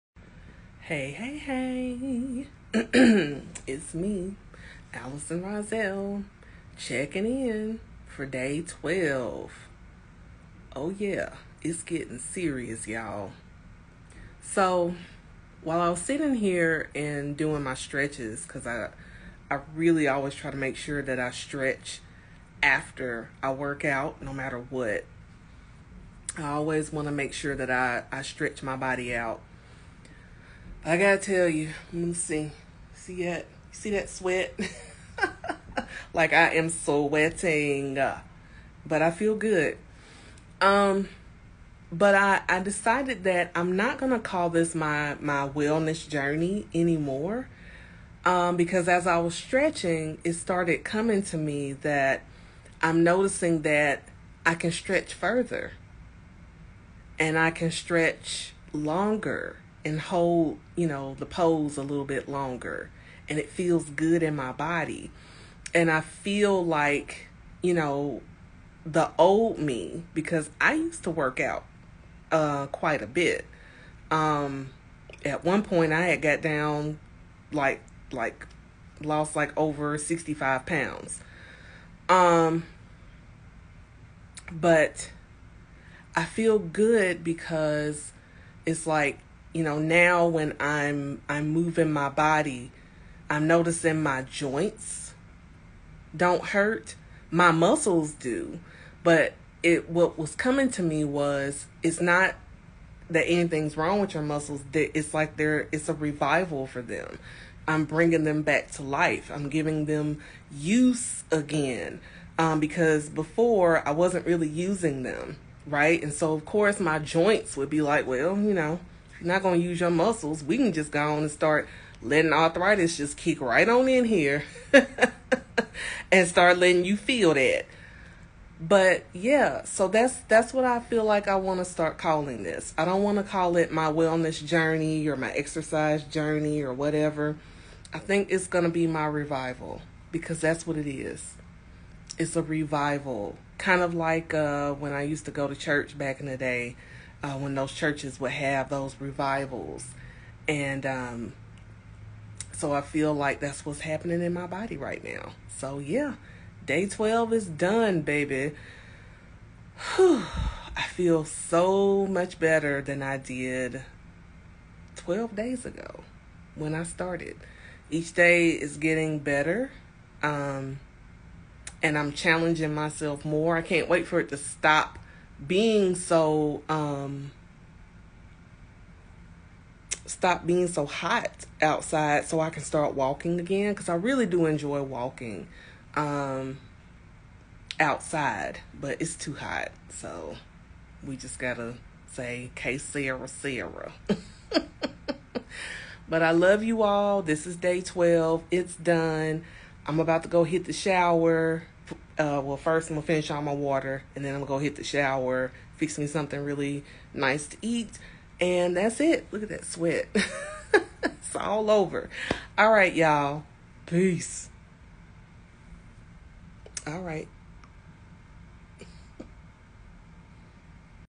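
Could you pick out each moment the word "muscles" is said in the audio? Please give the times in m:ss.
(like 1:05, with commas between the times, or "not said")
1:37, 1:44, 1:59.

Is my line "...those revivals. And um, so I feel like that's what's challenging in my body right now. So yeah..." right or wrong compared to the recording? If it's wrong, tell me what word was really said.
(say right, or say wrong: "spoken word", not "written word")
wrong: "happening", not "challenging".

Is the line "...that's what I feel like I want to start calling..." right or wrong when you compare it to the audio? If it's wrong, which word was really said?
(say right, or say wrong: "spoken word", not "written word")
right.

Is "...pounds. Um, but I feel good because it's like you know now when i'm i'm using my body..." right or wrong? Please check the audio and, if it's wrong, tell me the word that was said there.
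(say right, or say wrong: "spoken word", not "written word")
wrong: "moving", not "using".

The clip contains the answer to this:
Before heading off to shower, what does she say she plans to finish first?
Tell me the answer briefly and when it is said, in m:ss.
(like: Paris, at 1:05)
all my water, at 3:23.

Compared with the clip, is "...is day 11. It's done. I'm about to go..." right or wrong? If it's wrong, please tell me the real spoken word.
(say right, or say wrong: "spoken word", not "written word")
wrong: "12", not "11".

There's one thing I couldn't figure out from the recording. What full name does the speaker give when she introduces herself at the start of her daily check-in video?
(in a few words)
Allison Roselle.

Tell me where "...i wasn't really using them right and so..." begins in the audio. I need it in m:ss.
1:53.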